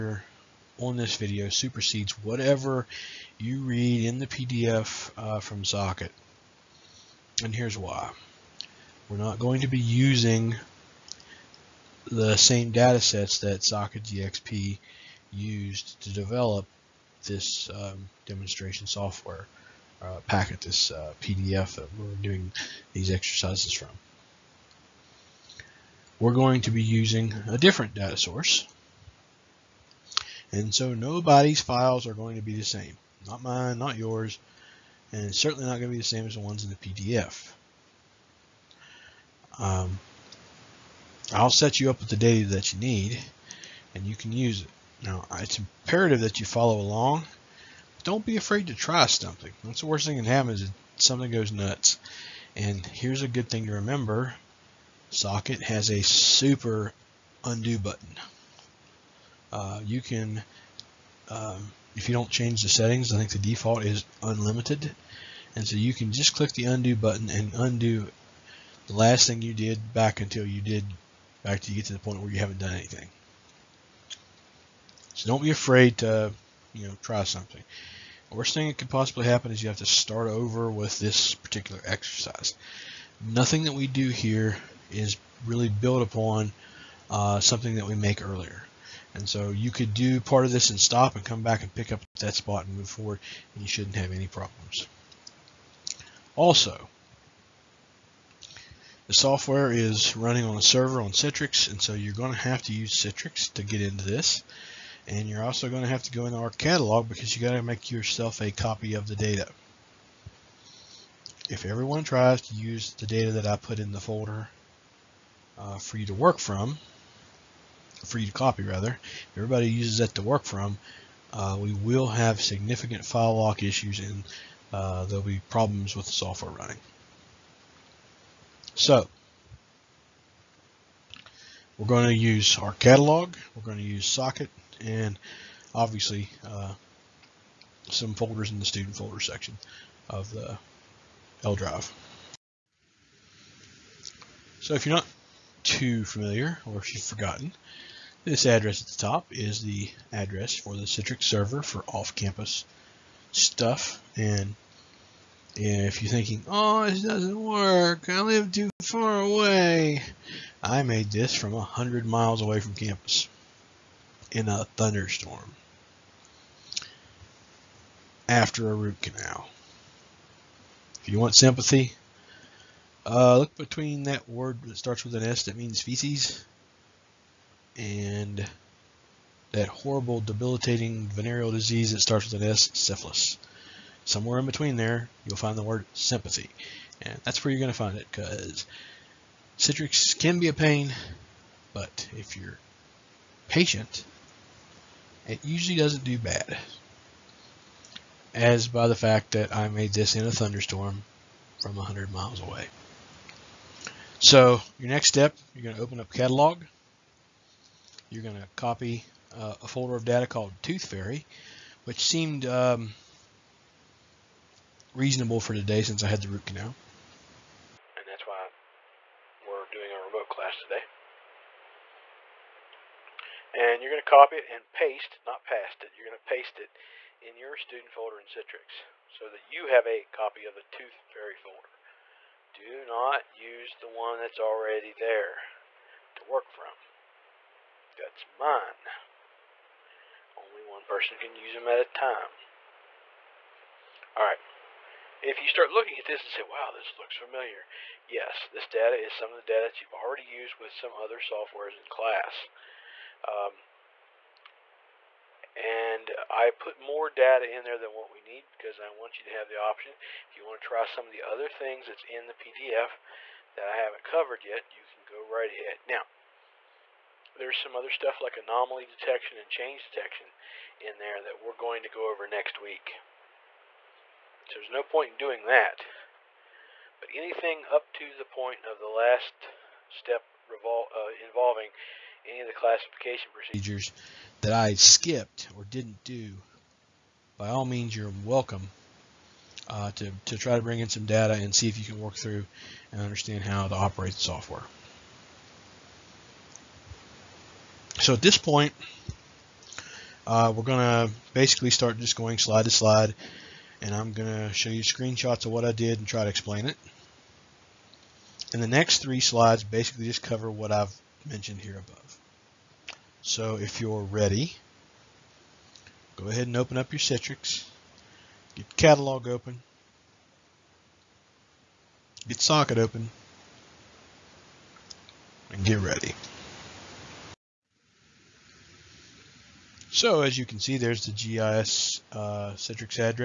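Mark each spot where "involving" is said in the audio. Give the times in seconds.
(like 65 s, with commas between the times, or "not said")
281 s.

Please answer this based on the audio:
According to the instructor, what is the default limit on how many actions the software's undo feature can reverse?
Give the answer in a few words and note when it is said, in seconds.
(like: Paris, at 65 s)
unlimited, at 64 s.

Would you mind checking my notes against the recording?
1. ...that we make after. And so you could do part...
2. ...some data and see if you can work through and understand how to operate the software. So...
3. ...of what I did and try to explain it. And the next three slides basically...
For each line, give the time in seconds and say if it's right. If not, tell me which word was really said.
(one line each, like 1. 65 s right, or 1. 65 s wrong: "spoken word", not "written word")
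1. 87 s wrong: "earlier", not "after"
2. 290 s right
3. 305 s right.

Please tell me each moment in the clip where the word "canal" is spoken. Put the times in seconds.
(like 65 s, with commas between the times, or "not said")
169 s, 216 s.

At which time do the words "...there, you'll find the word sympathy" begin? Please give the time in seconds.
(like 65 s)
184 s.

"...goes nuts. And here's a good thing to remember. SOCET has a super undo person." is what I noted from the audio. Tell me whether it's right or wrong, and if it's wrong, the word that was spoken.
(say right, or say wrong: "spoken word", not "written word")
wrong: "button", not "person".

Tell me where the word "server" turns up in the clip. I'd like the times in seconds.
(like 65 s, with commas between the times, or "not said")
100 s, 151 s.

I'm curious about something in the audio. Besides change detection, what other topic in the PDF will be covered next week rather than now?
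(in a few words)
anomaly detection.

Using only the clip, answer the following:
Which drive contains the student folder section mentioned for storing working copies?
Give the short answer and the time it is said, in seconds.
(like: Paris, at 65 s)
L drive, at 141 s.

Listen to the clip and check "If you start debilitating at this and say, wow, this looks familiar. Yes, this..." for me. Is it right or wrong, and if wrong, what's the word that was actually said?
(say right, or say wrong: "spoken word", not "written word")
wrong: "looking", not "debilitating".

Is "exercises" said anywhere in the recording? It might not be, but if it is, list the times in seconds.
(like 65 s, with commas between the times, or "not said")
23 s, 81 s.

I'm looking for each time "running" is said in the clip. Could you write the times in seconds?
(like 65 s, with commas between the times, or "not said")
100 s, 126 s.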